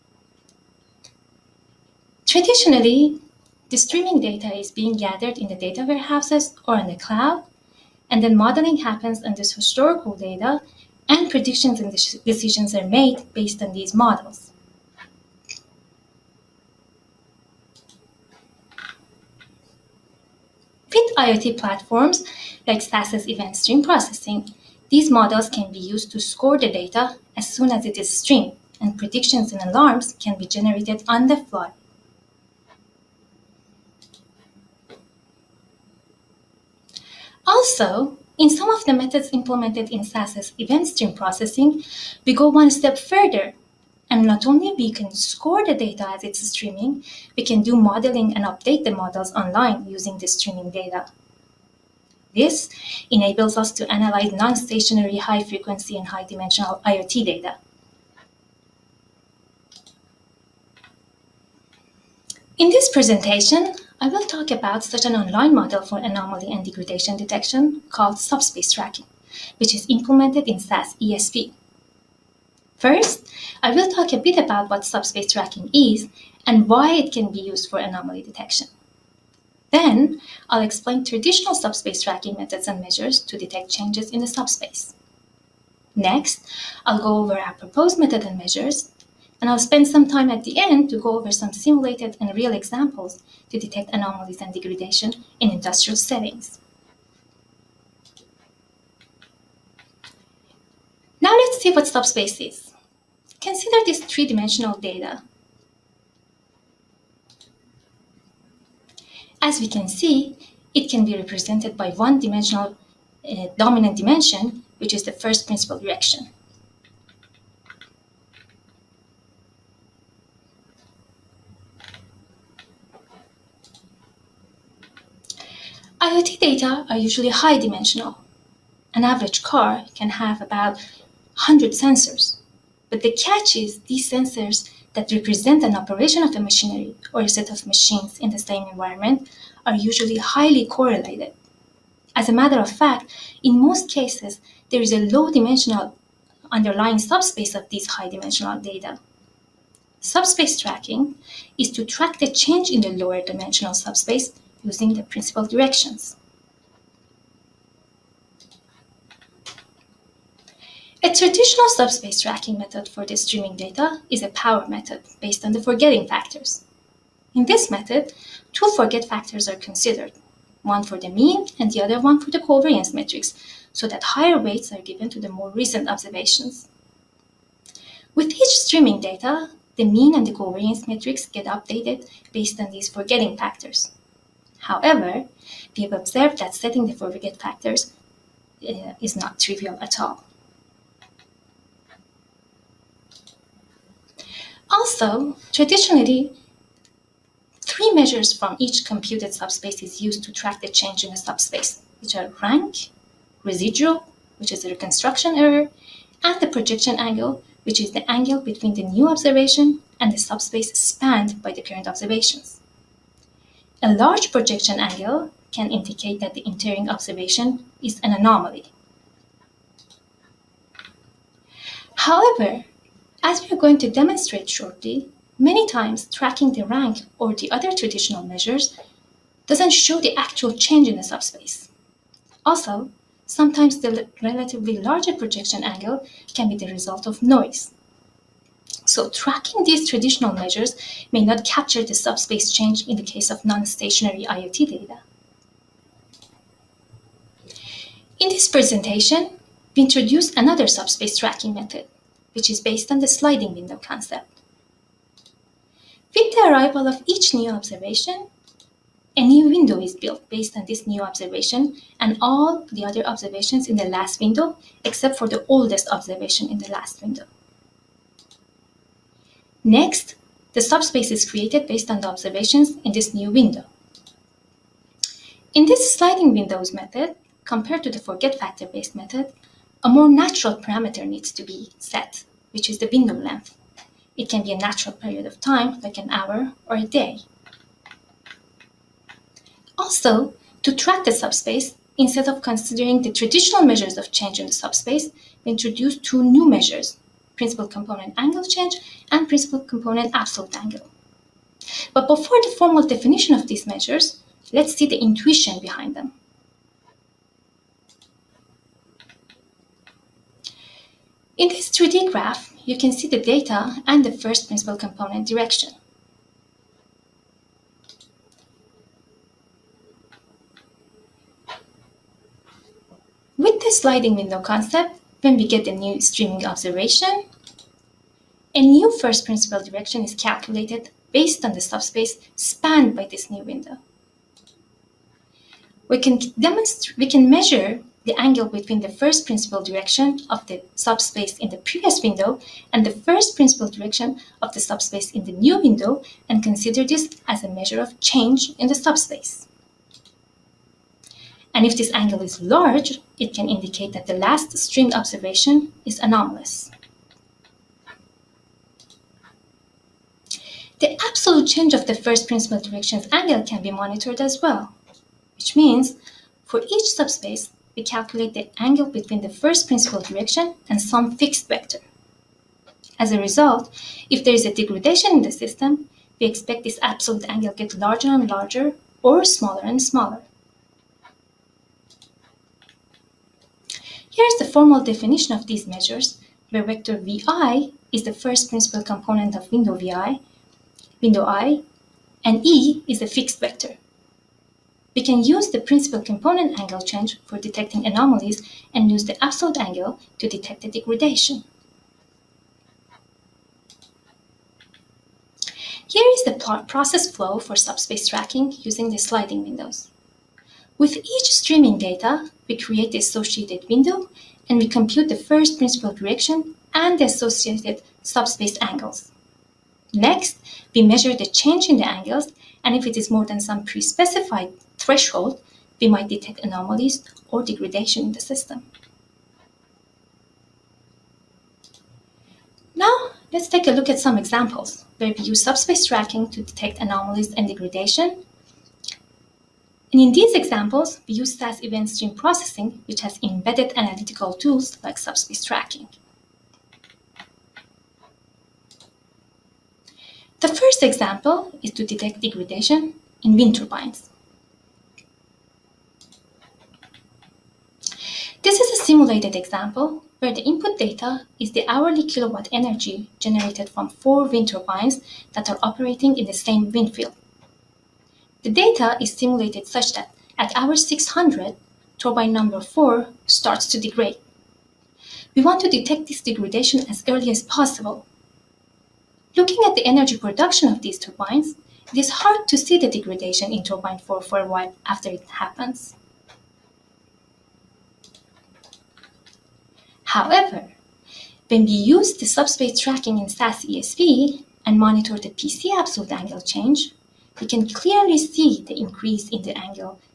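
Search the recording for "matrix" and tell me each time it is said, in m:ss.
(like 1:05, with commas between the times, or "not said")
2:52, 3:00.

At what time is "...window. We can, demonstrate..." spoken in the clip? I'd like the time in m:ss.
5:33.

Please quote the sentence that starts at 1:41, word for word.
Now let's see what subspace is this three-dimensional data.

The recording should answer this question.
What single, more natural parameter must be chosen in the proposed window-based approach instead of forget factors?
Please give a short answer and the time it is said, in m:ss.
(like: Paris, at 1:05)
window length, at 4:42.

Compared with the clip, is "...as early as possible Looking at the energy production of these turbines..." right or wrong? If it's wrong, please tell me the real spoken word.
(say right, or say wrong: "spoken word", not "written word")
right.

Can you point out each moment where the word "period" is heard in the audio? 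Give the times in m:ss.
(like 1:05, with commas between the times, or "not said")
4:44.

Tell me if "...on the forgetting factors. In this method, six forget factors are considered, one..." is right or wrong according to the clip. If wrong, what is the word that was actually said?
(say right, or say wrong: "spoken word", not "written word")
wrong: "two", not "six".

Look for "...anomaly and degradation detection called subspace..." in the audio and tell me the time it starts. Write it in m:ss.
1:05.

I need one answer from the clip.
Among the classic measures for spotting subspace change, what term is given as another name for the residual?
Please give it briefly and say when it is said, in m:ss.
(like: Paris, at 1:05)
reconstruction error, at 3:24.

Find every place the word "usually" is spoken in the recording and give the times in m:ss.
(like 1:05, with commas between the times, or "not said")
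2:06, 2:19.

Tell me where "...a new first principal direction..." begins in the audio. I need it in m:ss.
5:28.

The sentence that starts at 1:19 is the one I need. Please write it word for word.
Then, I'll explain traditional subspace tracking methods and measures to detect changes in the subspace.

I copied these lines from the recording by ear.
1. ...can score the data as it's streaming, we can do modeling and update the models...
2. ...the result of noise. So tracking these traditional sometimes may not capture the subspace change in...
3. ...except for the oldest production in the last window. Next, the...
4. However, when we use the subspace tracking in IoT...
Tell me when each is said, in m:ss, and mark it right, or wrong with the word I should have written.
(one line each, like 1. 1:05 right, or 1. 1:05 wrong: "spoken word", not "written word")
1. 0:44 right
2. 3:56 wrong: "measures", not "sometimes"
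3. 4:24 wrong: "observation", not "production"
4. 8:10 wrong: "SAS", not "IoT".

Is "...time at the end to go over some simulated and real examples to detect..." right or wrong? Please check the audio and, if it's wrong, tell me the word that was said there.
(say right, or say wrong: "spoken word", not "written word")
right.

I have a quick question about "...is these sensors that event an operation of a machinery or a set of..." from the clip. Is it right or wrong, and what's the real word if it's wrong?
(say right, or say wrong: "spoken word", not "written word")
wrong: "represent", not "event".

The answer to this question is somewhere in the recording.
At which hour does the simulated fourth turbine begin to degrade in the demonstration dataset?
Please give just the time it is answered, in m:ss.
7:50.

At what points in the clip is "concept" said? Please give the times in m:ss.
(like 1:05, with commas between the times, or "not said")
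4:13, 5:24.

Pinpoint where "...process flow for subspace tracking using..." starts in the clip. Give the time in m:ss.
6:46.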